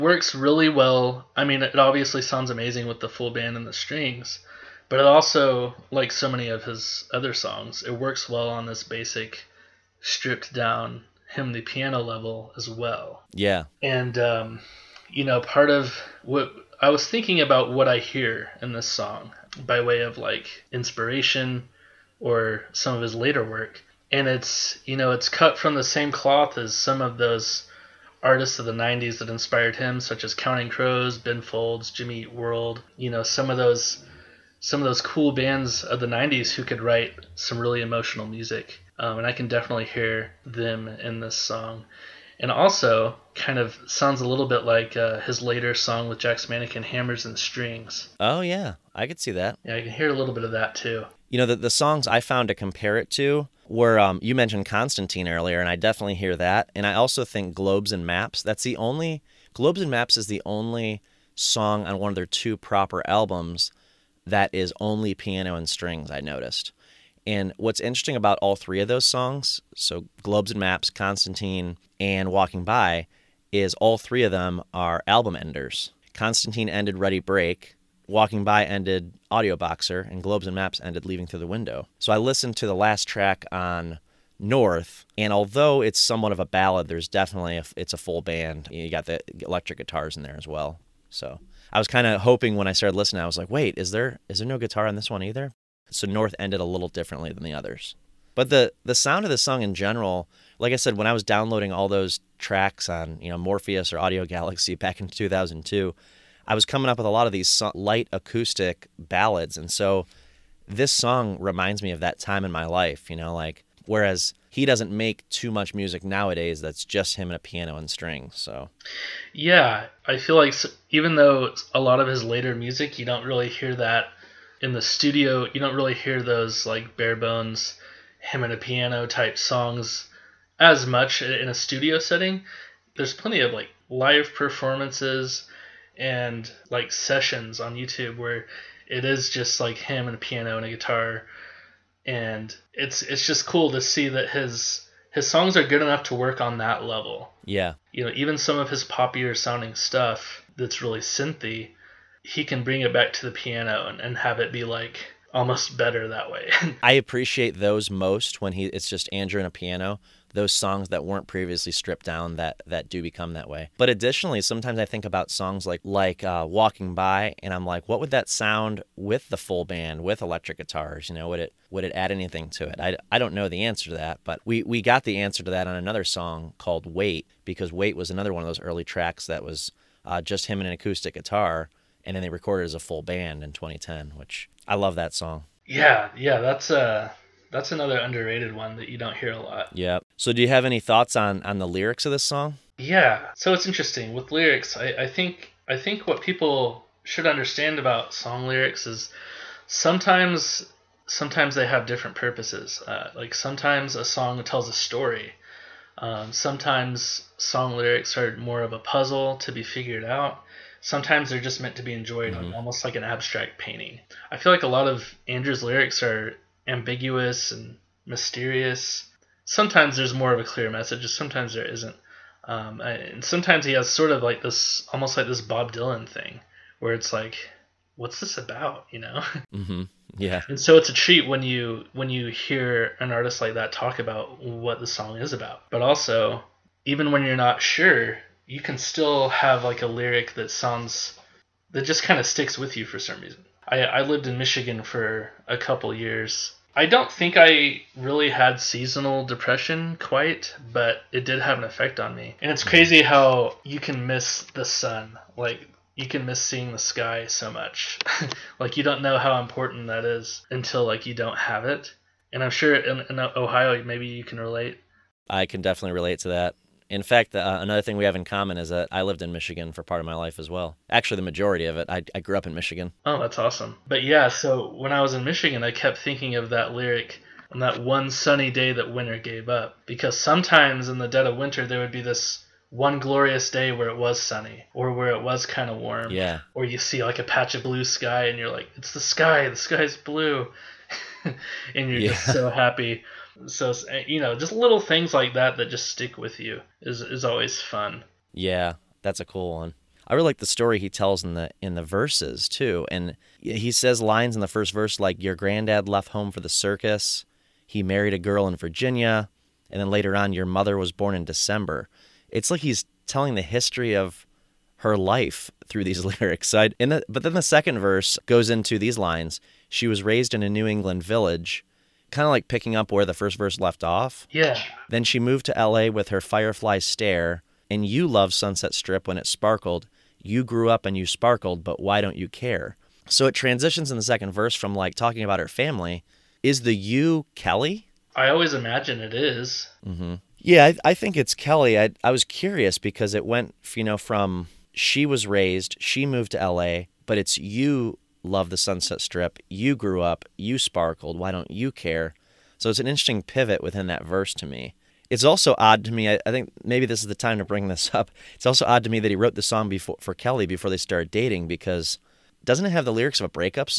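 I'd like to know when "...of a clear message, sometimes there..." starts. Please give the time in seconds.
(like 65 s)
220 s.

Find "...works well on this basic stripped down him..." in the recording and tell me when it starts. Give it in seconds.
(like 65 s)
7 s.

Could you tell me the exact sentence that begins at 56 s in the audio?
And I also think Globes and Maps.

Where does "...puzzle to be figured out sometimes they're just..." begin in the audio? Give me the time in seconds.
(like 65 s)
208 s.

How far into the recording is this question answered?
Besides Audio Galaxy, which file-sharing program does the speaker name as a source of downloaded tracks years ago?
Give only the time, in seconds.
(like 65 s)
103 s.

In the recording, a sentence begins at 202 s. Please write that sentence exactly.
Uh, like sometimes a song tells a story.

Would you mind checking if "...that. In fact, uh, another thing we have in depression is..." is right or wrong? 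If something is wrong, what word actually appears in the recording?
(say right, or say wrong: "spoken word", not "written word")
wrong: "common", not "depression".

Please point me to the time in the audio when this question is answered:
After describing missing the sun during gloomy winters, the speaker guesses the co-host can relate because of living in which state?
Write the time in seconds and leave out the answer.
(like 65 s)
263 s.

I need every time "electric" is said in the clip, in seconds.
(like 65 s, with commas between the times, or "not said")
89 s, 170 s.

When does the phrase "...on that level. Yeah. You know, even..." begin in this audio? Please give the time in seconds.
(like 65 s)
146 s.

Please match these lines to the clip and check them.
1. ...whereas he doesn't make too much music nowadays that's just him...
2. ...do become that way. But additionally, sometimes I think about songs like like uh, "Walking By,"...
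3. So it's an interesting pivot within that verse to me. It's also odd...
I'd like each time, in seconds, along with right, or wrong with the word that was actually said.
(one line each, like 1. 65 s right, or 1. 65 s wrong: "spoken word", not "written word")
1. 113 s right
2. 162 s right
3. 352 s right.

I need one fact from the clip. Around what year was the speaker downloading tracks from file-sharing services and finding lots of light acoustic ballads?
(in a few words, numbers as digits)
2002.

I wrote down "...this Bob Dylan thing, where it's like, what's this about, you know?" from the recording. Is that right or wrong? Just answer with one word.
right.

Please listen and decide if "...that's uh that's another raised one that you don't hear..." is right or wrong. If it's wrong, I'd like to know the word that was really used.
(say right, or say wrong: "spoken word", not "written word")
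wrong: "underrated", not "raised".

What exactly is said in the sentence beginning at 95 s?
So North ended a little differently than the others.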